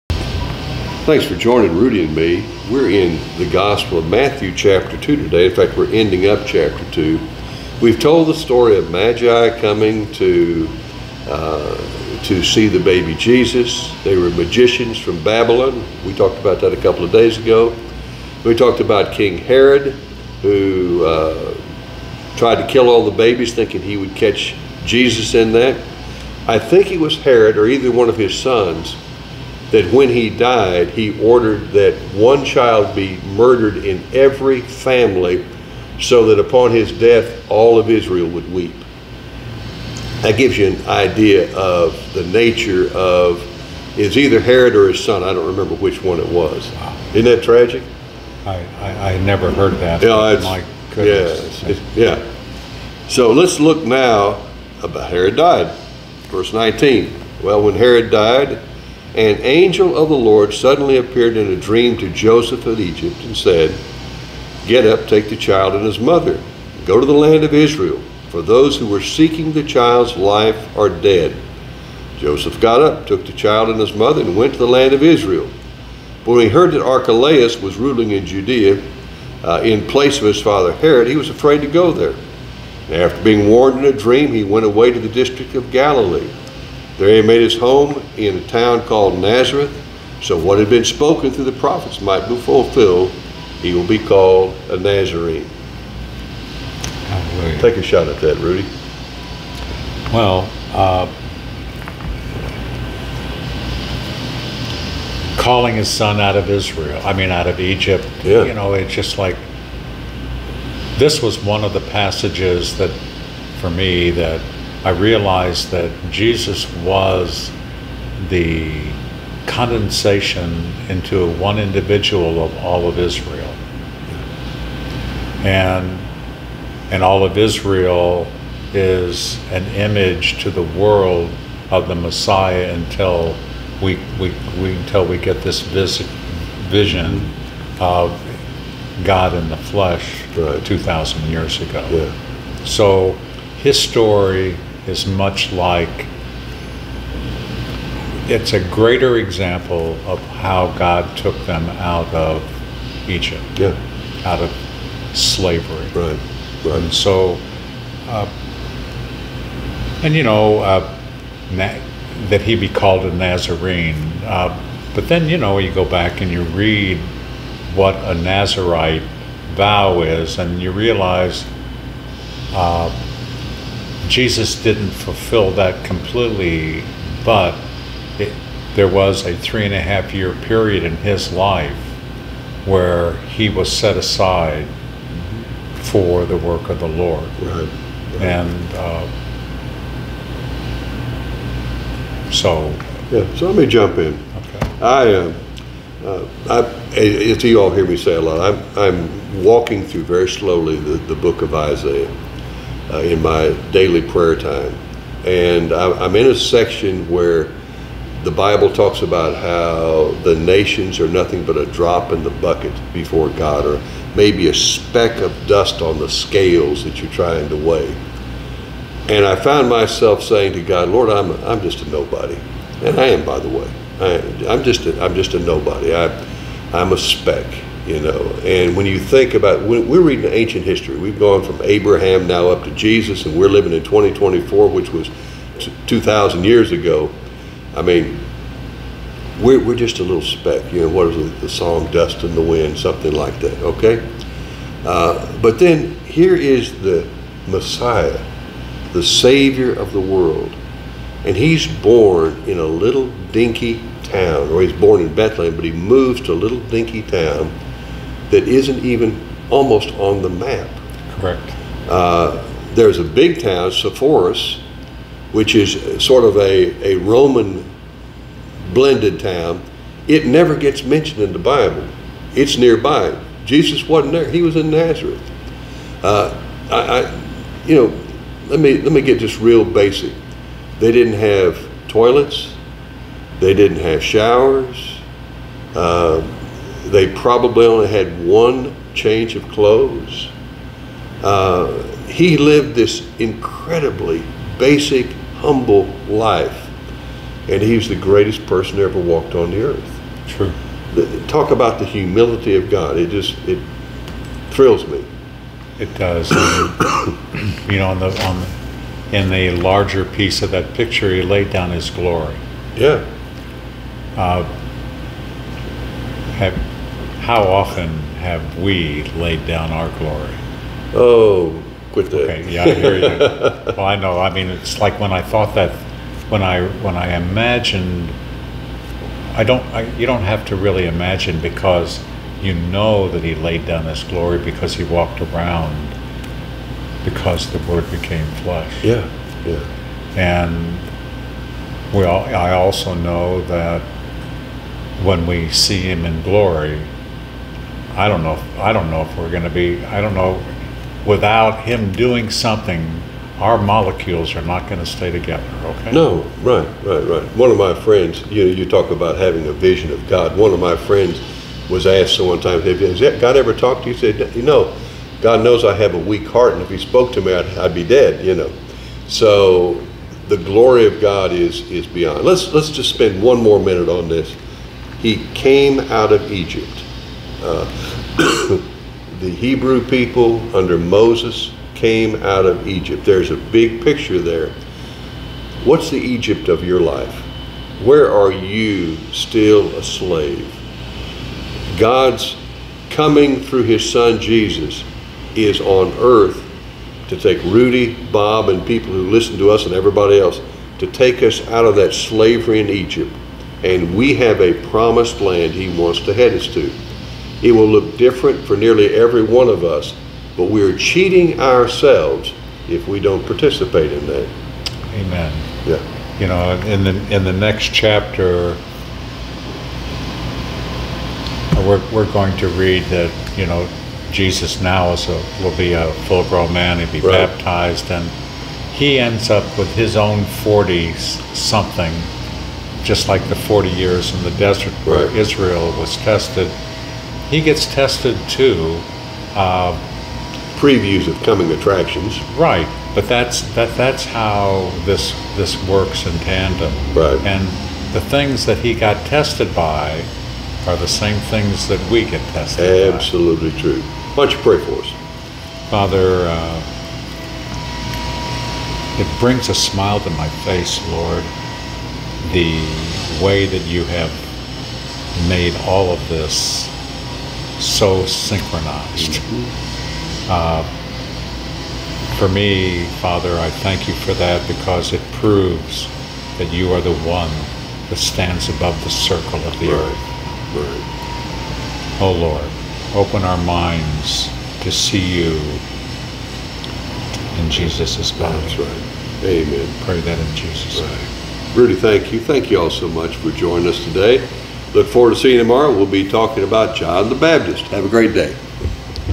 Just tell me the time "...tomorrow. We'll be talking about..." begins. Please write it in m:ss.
8:15.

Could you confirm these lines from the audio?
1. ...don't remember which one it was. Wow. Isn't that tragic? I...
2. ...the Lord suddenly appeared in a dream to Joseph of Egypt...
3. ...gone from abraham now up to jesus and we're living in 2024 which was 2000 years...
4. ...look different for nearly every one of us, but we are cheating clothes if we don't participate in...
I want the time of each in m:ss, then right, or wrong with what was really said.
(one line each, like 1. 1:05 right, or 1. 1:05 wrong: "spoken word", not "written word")
1. 0:45 right
2. 1:00 right
3. 3:51 right
4. 6:47 wrong: "ourselves", not "clothes".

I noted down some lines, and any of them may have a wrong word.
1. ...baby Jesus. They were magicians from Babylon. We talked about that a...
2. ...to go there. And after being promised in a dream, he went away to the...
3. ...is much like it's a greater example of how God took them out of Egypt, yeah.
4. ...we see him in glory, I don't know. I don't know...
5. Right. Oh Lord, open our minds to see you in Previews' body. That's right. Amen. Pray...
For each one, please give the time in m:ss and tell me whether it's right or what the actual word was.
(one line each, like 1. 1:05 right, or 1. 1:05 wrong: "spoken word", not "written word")
1. 0:12 right
2. 1:21 wrong: "warned", not "promised"
3. 2:24 right
4. 5:45 right
5. 8:00 wrong: "Jesus", not "Previews".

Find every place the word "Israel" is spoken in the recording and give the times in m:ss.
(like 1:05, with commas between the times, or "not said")
0:37, 1:07, 1:15, 1:46, 2:02, 2:07, 7:15.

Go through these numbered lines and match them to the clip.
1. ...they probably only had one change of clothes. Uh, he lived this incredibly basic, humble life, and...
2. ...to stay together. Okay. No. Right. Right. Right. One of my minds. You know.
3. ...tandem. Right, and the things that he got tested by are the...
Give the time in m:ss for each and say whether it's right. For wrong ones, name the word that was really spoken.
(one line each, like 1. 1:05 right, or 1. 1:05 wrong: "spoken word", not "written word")
1. 4:46 right
2. 5:54 wrong: "friends", not "minds"
3. 7:26 right.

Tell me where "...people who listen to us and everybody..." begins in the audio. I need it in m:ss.
6:38.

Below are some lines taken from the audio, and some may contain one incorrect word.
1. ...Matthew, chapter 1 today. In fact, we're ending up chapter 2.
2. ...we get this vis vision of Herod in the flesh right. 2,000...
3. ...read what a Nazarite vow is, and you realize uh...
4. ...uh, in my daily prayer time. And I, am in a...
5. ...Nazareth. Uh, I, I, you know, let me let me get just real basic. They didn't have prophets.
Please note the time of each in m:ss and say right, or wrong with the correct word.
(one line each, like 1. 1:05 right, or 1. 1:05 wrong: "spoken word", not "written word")
1. 0:04 wrong: "2", not "1"
2. 2:15 wrong: "God", not "Herod"
3. 2:46 right
4. 3:22 right
5. 4:34 wrong: "toilets", not "prophets".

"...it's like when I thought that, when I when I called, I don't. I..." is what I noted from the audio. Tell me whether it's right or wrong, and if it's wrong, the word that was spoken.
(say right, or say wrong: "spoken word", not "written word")
wrong: "imagined", not "called".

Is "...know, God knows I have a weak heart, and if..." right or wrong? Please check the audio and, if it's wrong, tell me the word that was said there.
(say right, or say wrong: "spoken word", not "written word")
right.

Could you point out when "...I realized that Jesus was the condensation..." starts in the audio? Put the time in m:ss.
1:54.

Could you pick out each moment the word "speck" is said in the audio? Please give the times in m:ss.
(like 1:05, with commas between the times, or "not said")
3:34, 3:46, 4:00.